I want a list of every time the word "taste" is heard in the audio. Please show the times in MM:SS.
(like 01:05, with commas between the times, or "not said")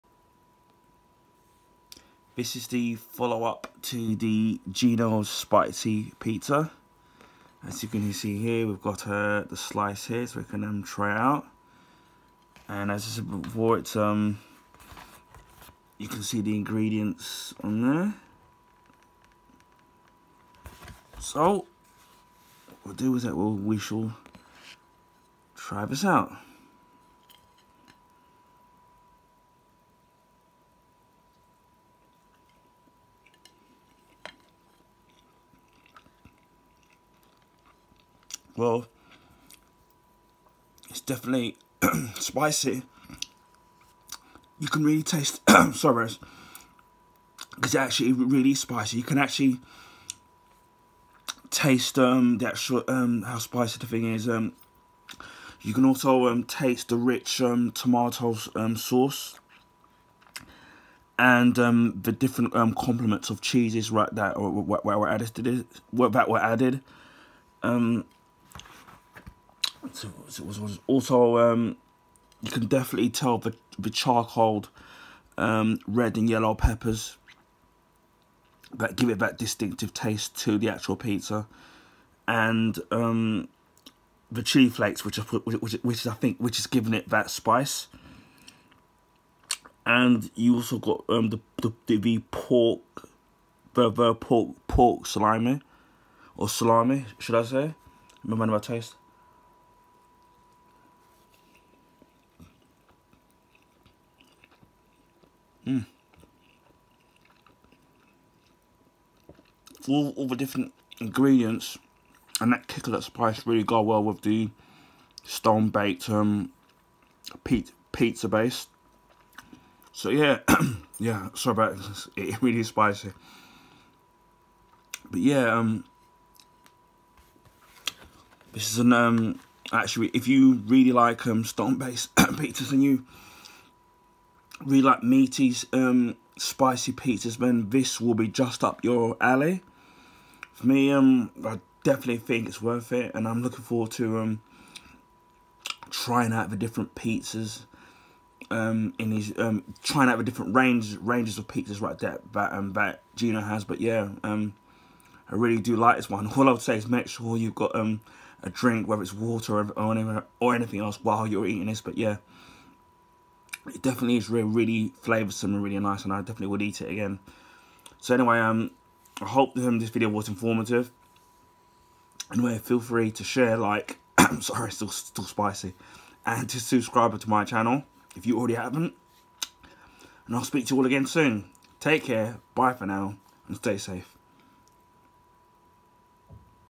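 00:45, 00:51, 00:56, 01:19, 01:38.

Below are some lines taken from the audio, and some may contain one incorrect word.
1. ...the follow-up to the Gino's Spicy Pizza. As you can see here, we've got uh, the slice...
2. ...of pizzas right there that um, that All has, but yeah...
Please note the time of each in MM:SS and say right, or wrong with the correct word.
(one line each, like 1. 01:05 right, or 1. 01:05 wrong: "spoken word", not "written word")
1. 00:02 right
2. 02:31 wrong: "Gino", not "All".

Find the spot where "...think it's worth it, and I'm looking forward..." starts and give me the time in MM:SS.
02:22.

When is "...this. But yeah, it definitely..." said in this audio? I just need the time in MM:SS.
02:41.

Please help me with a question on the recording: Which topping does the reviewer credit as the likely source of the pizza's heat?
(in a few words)
Chili flakes.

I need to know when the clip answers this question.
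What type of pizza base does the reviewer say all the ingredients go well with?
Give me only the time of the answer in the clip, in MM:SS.
01:55.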